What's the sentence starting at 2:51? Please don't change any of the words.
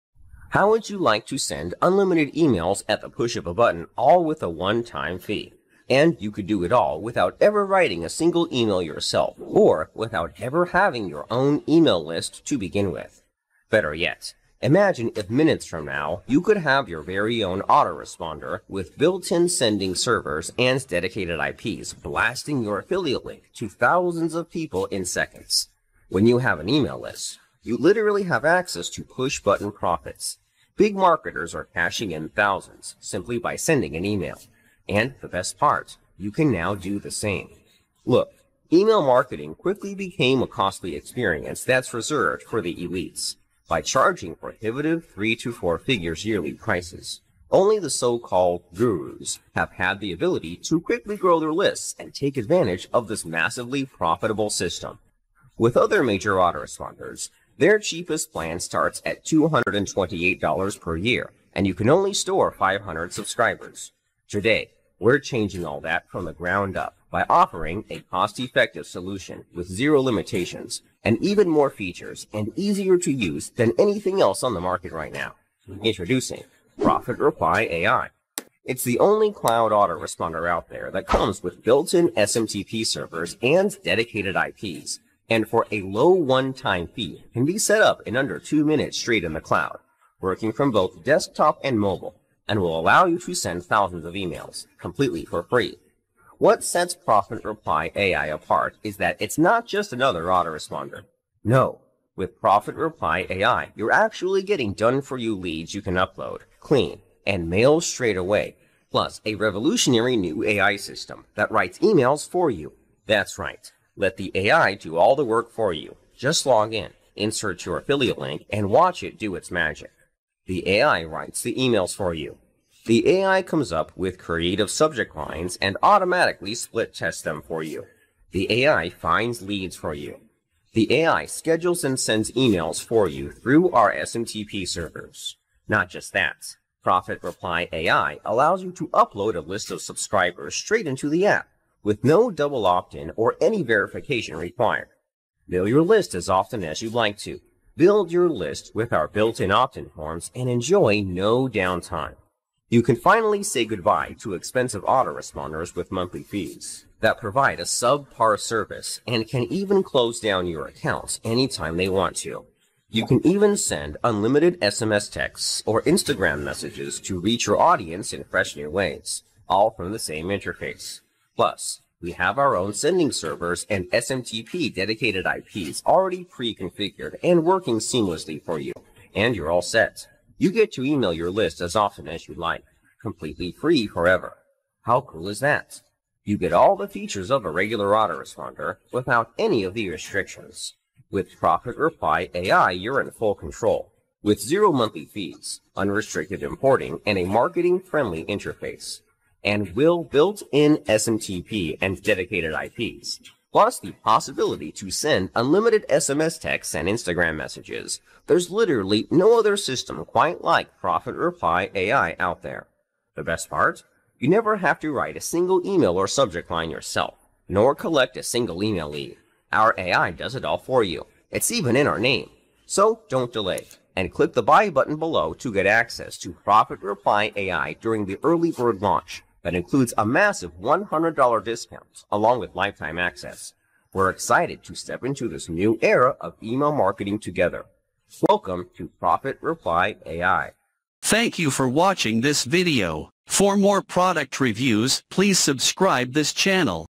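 Plus, we have our own sending servers and SMTP dedicated IPs already pre-configured and working seamlessly for you, and you're all set.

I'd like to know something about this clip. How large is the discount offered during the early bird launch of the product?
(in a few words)
$100.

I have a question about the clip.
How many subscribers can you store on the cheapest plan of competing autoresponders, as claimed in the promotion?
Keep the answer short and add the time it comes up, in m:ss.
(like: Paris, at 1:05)
500, at 1:02.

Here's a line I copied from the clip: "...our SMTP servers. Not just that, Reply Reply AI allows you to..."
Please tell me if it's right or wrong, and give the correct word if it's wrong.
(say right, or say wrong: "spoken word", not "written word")
wrong: "Profit", not "Reply".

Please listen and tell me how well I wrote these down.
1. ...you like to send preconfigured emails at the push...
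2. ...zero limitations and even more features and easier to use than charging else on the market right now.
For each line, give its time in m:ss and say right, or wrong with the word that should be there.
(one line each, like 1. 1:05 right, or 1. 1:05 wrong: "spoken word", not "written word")
1. 0:00 wrong: "unlimited", not "preconfigured"
2. 1:09 wrong: "anything", not "charging".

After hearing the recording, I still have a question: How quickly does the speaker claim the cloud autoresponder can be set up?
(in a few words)
under two minutes.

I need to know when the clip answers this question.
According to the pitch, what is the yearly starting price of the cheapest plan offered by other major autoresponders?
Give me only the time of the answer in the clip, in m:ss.
0:59.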